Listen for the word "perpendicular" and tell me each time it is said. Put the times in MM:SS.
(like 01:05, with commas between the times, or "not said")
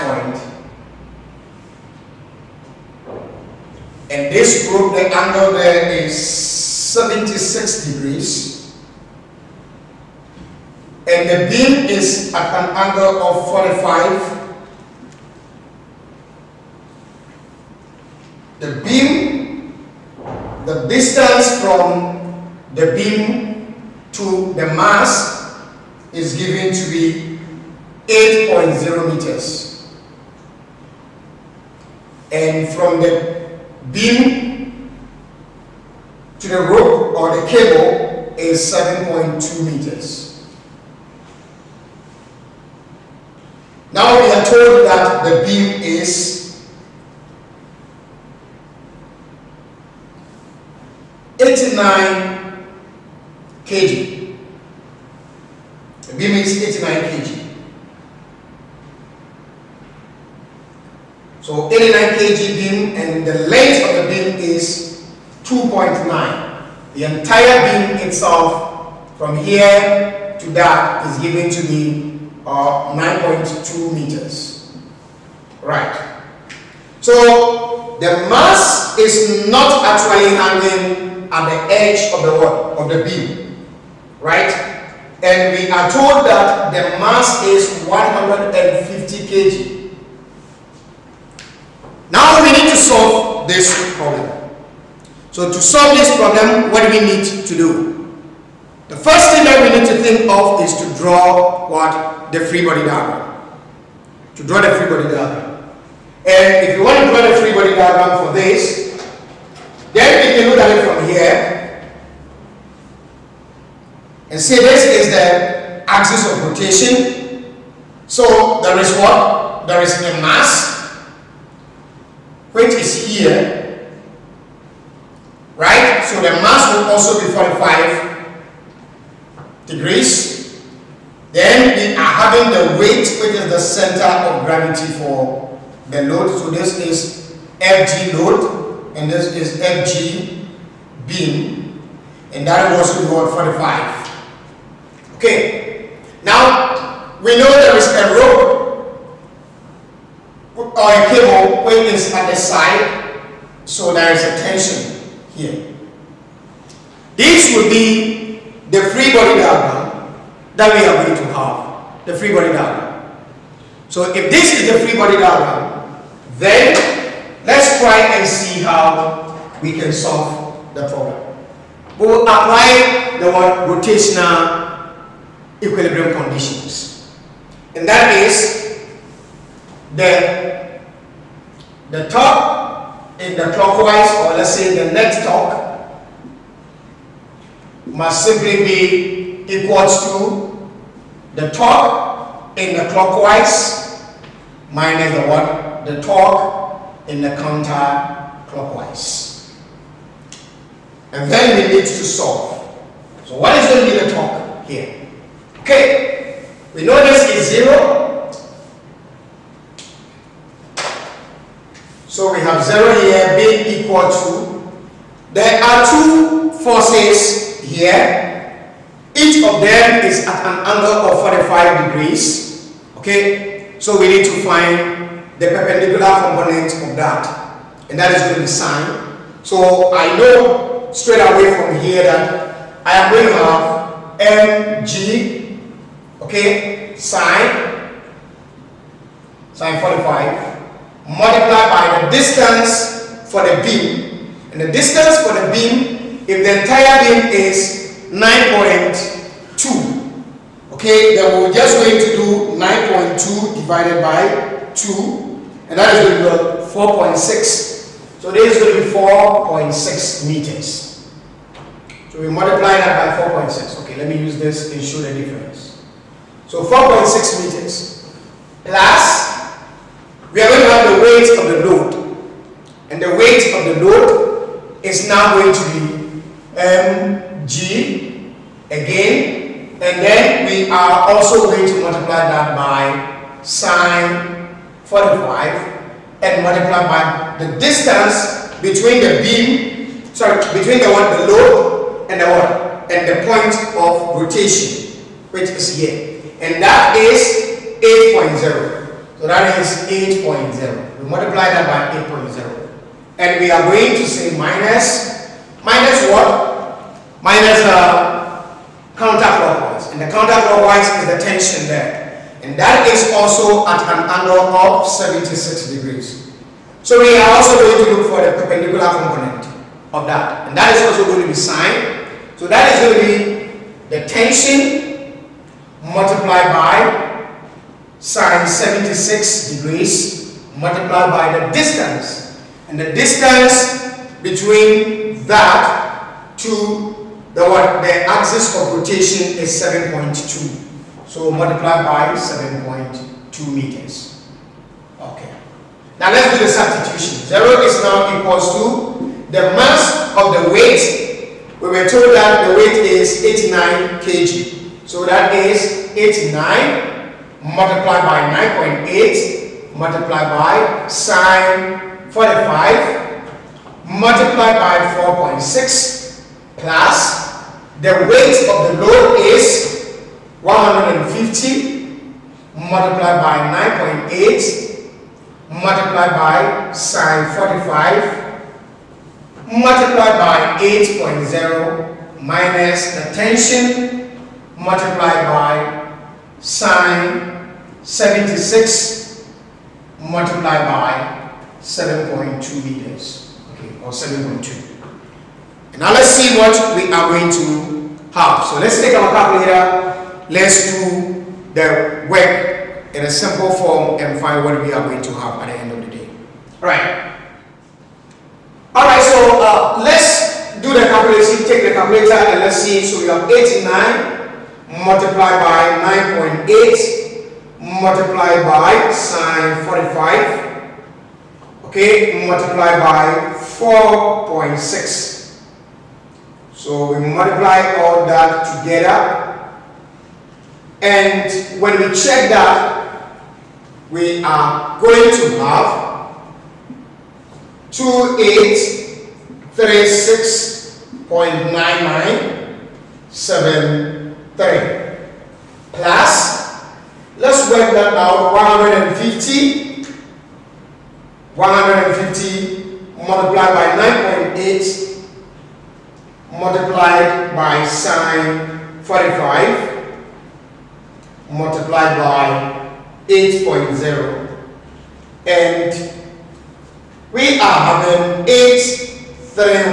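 03:45, 05:18.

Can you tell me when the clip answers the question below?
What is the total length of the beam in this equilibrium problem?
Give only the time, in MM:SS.
01:12.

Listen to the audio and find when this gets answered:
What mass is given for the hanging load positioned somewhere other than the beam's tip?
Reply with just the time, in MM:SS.
01:27.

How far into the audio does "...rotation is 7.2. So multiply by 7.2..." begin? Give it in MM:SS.
05:38.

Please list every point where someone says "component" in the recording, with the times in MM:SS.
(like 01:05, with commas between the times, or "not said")
03:46, 05:18.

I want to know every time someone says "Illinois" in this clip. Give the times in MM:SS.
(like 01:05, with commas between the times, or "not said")
not said.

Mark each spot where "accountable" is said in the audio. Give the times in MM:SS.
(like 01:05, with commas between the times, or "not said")
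not said.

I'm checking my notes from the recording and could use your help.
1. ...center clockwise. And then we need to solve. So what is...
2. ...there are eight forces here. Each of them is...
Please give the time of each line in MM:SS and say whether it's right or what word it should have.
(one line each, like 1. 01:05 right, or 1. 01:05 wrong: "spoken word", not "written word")
1. 03:17 wrong: "counter", not "center"
2. 03:35 wrong: "two", not "eight".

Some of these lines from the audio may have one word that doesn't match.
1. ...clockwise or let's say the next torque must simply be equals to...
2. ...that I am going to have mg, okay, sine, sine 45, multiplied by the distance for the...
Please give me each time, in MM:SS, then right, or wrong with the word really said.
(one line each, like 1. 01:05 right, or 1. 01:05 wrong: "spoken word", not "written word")
1. 03:03 right
2. 03:52 right.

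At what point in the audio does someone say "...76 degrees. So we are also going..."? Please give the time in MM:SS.
05:14.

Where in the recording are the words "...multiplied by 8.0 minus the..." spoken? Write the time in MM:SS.
06:19.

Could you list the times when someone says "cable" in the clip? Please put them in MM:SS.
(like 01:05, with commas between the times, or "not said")
00:37, 02:31.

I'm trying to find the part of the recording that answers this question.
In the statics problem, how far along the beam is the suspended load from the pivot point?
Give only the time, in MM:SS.
00:28.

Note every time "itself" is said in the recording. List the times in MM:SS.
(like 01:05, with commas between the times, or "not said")
01:08.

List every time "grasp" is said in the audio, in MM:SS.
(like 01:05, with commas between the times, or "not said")
not said.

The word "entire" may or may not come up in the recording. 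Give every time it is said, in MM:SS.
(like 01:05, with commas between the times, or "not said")
01:07, 04:06.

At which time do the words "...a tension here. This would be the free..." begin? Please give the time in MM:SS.
02:34.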